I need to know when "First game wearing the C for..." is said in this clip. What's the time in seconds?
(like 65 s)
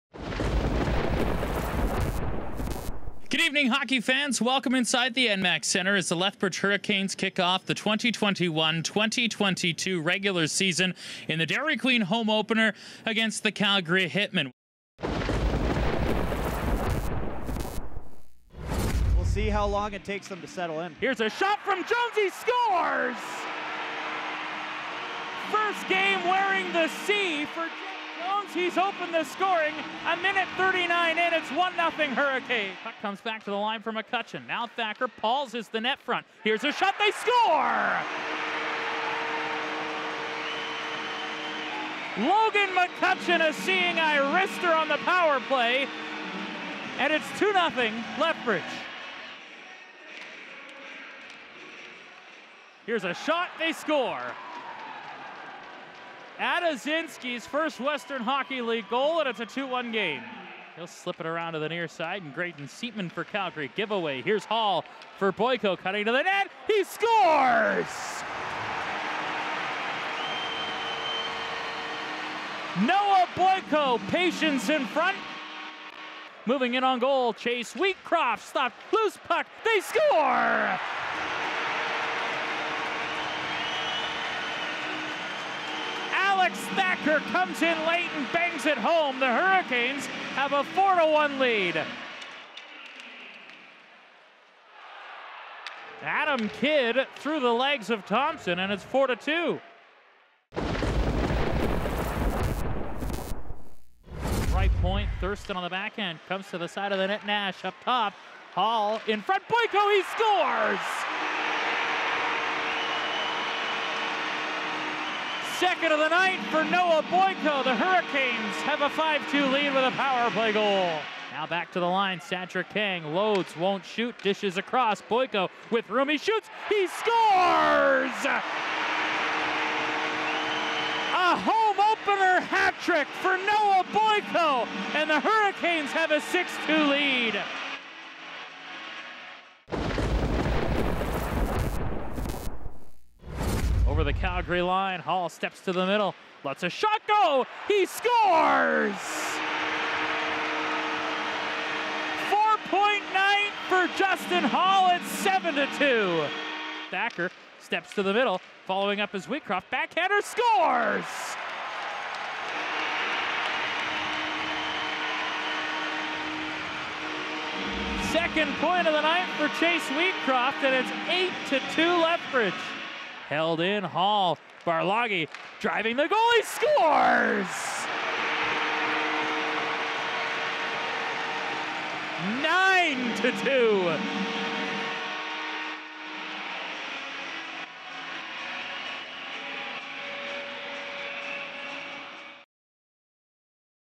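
25 s.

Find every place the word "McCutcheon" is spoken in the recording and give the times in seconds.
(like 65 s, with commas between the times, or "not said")
33 s, 42 s.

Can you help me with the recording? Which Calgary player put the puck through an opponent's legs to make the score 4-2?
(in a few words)
Adam Kidd.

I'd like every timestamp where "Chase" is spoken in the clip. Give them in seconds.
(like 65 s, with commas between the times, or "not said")
77 s, 169 s.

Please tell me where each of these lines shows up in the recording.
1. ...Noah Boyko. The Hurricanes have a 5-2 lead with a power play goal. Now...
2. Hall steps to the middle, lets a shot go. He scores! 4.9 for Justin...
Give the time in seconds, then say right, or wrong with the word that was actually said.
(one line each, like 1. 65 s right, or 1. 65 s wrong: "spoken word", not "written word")
1. 116 s right
2. 144 s right.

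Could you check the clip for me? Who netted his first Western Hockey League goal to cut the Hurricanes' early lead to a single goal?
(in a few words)
Adazinski.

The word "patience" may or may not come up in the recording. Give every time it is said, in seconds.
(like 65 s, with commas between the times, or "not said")
74 s.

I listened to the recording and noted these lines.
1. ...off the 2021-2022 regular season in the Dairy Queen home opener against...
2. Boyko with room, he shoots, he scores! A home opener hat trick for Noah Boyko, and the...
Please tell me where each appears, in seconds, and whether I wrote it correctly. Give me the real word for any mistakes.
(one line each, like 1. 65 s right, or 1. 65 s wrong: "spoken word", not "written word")
1. 7 s right
2. 125 s right.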